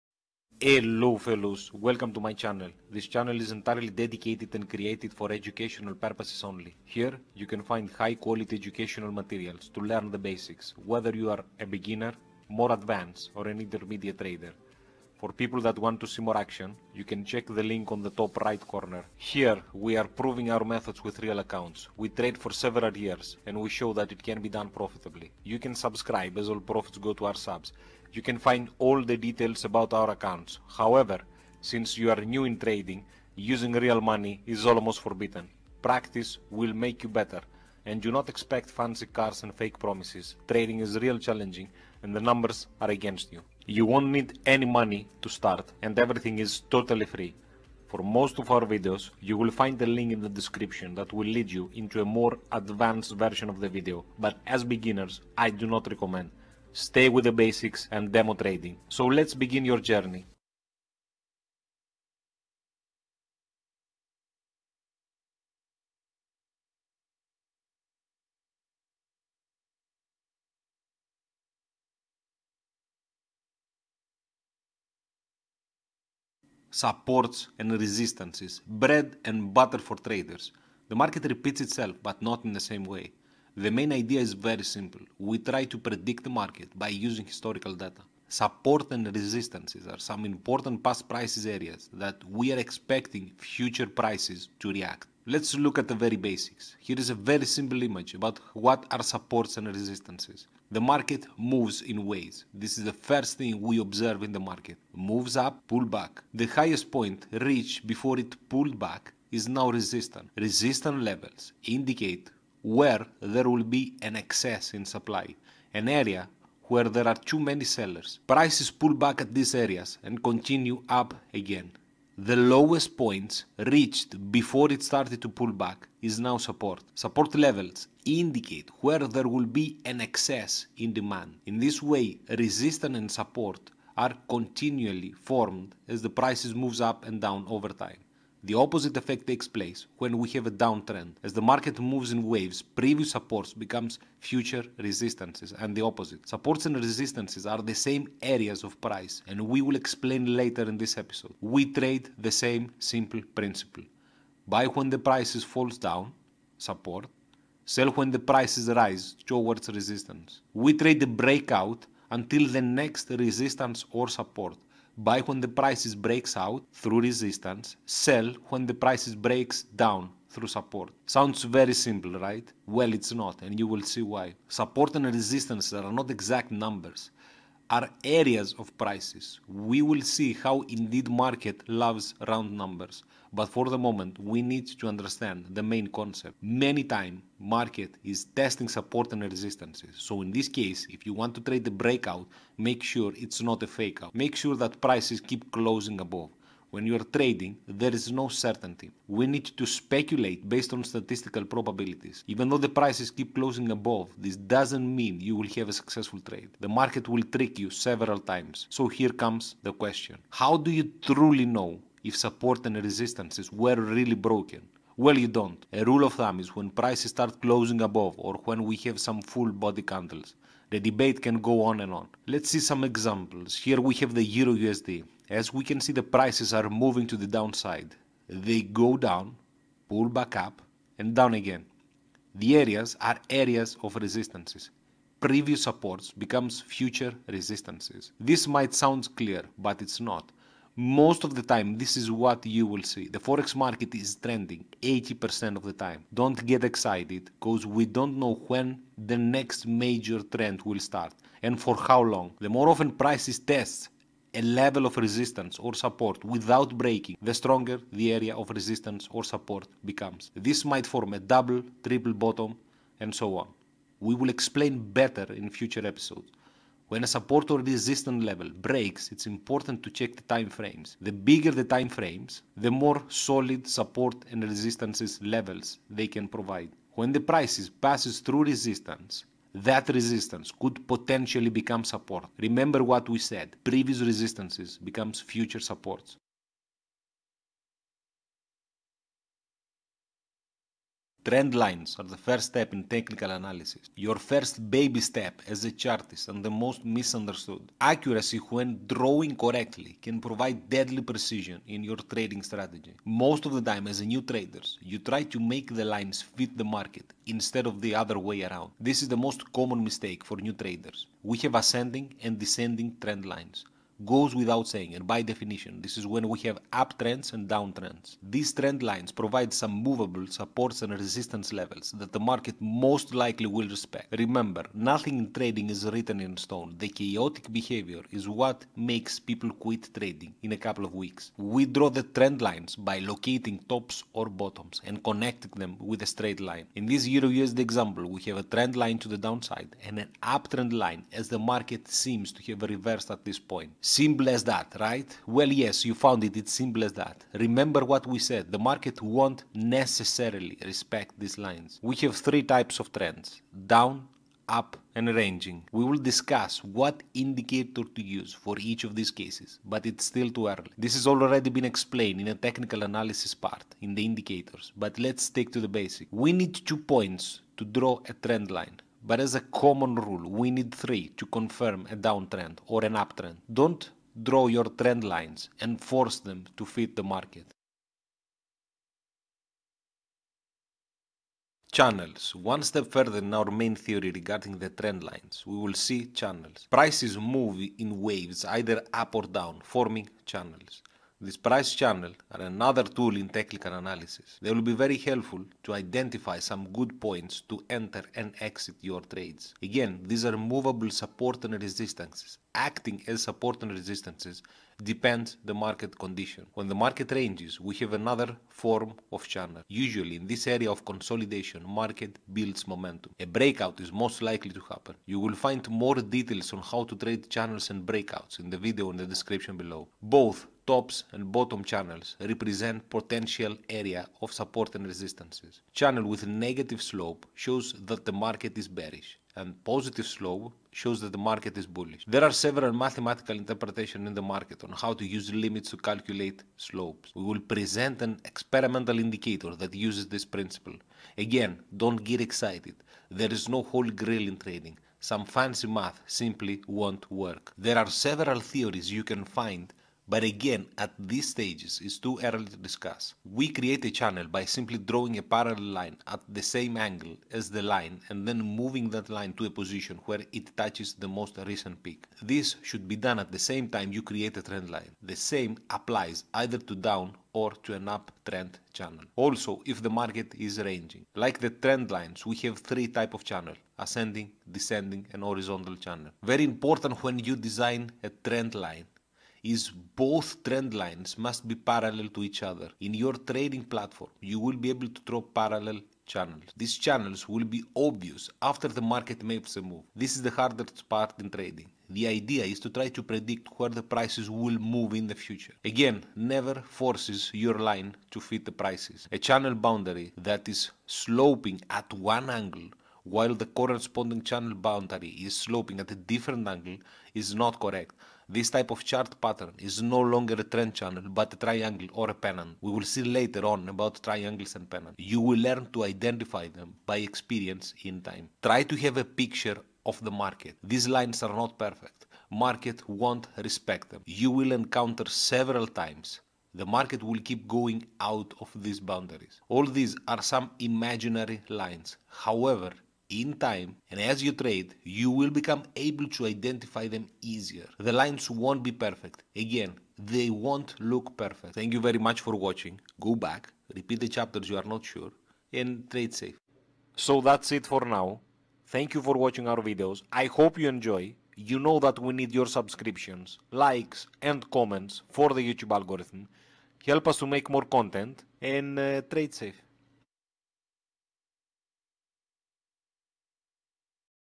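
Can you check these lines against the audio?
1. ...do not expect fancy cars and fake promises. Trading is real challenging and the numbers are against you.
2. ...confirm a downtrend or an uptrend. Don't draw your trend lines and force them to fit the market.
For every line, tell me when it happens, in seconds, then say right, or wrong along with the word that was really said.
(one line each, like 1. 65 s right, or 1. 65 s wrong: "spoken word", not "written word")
1. 38 s right
2. 371 s right.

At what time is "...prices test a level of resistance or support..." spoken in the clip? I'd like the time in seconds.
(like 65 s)
252 s.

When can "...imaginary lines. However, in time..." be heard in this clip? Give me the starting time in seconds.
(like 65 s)
530 s.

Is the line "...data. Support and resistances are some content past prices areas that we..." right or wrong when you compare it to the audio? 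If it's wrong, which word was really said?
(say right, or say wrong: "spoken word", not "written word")
wrong: "important", not "content".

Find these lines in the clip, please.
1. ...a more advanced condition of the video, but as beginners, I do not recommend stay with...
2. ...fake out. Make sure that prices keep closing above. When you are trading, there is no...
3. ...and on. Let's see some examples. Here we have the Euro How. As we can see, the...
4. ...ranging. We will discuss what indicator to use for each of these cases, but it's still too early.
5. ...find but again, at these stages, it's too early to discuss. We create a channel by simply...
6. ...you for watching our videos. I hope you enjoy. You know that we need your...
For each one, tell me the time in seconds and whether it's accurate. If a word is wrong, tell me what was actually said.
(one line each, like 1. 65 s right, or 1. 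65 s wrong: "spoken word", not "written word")
1. 52 s wrong: "version", not "condition"
2. 193 s right
3. 221 s wrong: "USD", not "How"
4. 355 s right
5. 449 s right
6. 548 s right.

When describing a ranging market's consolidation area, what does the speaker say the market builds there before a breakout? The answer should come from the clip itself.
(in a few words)
Momentum.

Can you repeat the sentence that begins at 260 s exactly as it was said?
This might form a double, triple bottom, and so on.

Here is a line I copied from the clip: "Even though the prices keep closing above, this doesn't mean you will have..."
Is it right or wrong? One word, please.
right.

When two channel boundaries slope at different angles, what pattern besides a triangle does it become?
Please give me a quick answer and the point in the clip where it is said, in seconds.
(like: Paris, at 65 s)
Pennant, at 512 s.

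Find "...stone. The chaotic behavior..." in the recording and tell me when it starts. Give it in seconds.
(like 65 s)
326 s.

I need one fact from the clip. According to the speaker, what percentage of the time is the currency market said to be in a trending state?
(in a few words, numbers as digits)
80%.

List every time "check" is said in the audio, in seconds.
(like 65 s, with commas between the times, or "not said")
17 s, 269 s.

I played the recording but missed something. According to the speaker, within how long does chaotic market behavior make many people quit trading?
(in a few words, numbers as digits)
A couple of weeks.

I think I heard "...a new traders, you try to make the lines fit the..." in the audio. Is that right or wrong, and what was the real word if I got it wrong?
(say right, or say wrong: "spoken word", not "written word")
right.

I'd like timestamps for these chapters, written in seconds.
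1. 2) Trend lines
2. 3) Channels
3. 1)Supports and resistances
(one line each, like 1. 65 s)
1. 288 s
2. 378 s
3. 70 s.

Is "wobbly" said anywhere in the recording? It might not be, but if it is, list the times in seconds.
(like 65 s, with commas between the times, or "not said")
not said.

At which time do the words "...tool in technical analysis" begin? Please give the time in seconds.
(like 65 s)
392 s.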